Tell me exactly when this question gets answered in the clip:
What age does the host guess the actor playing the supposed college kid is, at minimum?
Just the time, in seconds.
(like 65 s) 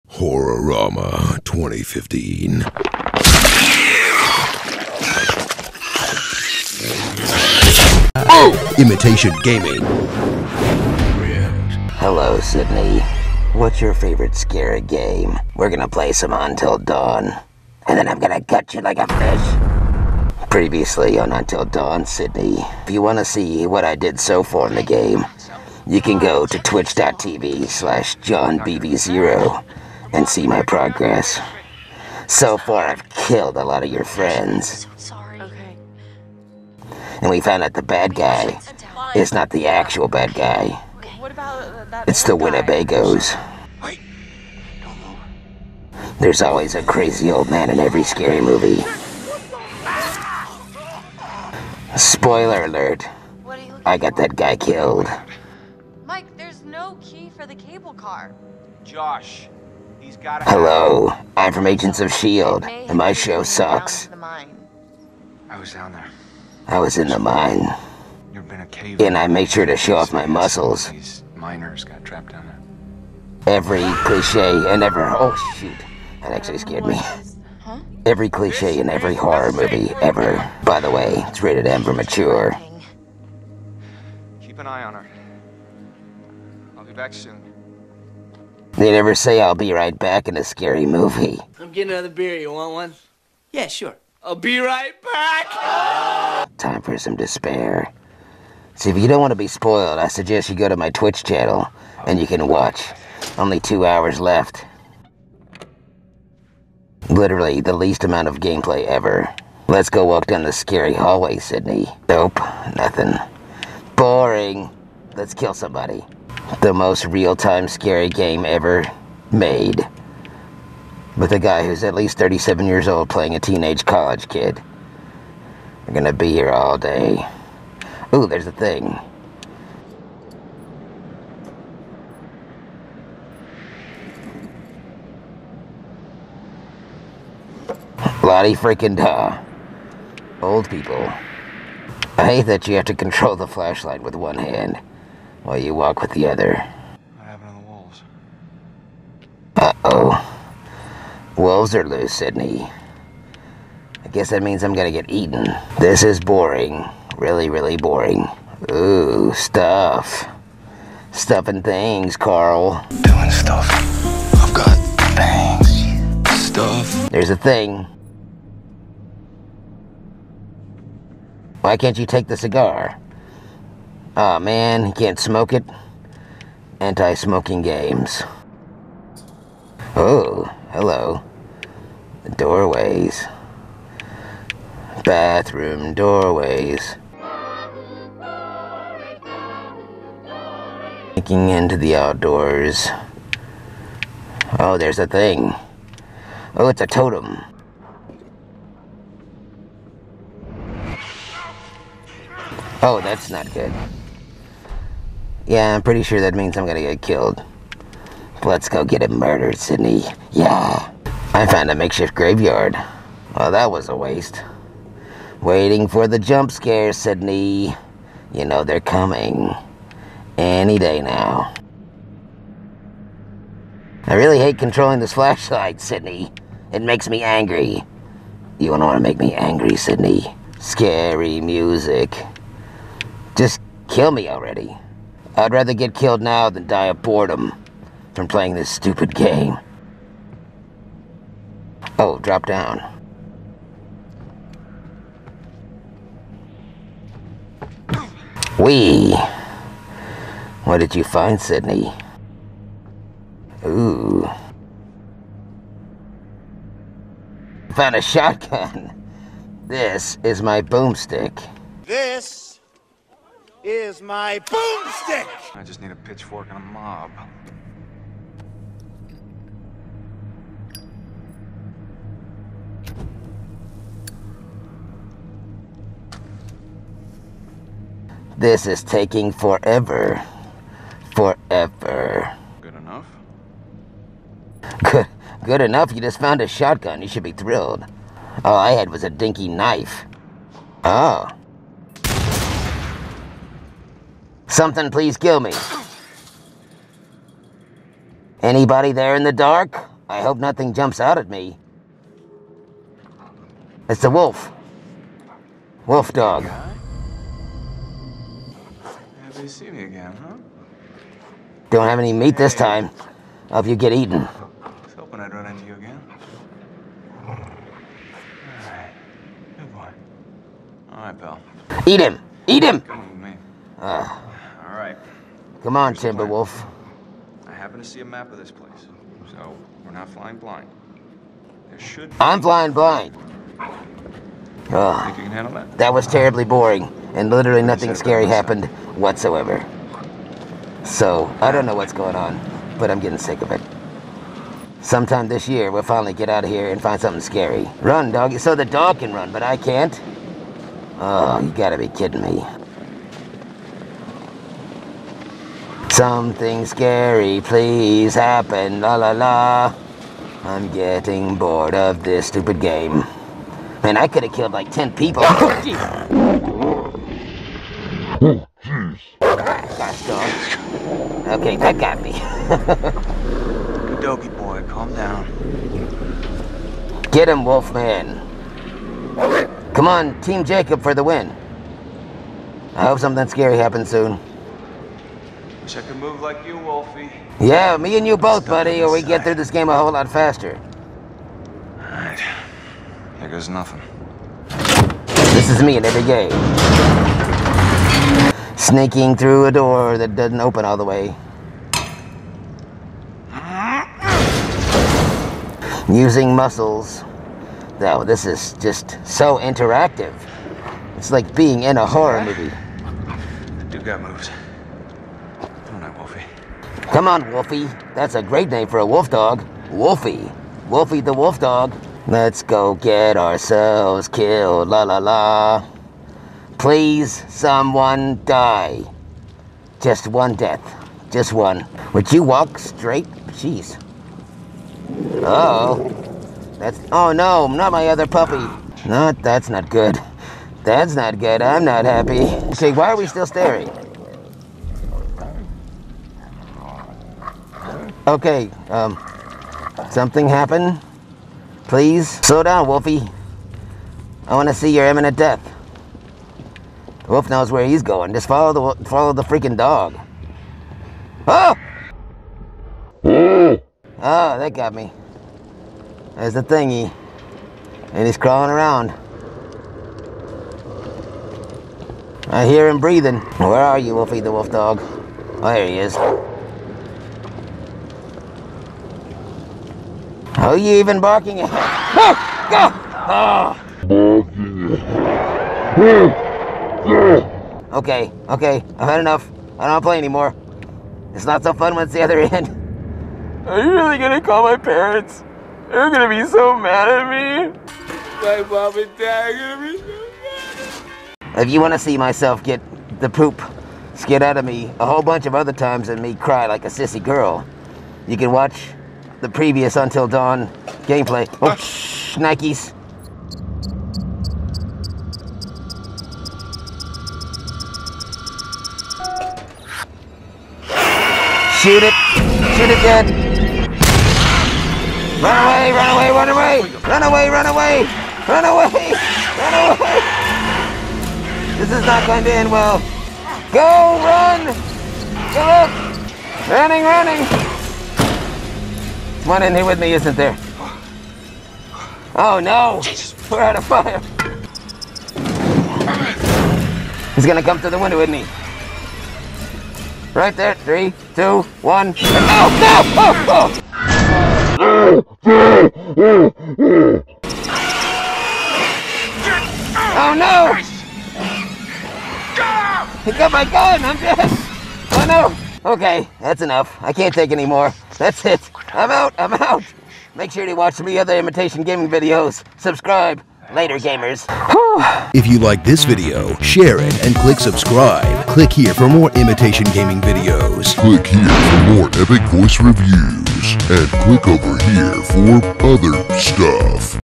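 122 s.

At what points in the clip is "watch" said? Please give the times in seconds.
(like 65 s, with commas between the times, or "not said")
102 s, 508 s, 570 s.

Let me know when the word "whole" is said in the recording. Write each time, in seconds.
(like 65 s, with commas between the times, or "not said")
389 s, 504 s.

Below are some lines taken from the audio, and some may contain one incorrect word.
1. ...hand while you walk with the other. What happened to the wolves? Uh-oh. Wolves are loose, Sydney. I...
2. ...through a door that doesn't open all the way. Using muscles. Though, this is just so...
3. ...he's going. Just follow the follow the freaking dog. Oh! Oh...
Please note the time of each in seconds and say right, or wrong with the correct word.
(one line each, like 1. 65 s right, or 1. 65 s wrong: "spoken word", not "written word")
1. 144 s right
2. 399 s right
3. 457 s right.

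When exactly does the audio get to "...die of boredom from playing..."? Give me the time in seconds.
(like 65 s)
236 s.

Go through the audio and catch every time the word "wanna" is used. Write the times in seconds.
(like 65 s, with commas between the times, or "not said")
23 s, 501 s.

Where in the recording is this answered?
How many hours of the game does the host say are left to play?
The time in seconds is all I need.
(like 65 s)
103 s.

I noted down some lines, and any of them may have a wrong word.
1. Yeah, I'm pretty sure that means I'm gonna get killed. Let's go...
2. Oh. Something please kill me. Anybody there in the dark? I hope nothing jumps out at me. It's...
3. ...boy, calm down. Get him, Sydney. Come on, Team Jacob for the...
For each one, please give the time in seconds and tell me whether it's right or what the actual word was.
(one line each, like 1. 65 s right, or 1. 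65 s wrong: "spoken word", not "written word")
1. 205 s right
2. 290 s right
3. 374 s wrong: "Wolfman", not "Sydney".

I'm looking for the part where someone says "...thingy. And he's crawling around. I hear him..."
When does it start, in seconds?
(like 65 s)
466 s.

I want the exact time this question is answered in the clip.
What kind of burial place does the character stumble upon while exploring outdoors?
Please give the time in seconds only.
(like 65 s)
211 s.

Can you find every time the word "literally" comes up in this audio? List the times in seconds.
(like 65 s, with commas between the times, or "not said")
107 s, 337 s.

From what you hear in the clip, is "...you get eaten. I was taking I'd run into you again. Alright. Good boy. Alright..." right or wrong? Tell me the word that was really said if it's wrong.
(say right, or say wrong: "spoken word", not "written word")
wrong: "hoping", not "taking".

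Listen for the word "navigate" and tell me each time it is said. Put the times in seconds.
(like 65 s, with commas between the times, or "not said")
not said.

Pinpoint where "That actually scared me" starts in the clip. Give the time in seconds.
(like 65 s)
76 s.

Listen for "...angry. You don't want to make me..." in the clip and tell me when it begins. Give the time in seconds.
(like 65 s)
227 s.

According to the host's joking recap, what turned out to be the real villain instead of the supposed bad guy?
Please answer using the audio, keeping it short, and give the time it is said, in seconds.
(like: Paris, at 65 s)
The Winnebagos, at 42 s.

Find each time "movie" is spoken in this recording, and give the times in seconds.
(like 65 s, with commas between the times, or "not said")
48 s, 79 s, 90 s, 412 s.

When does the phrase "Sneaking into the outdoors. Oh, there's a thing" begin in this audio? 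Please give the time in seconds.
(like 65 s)
191 s.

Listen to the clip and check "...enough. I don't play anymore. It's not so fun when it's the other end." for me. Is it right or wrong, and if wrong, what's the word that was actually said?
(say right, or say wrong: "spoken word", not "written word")
right.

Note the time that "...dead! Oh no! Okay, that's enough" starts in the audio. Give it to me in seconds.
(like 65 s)
563 s.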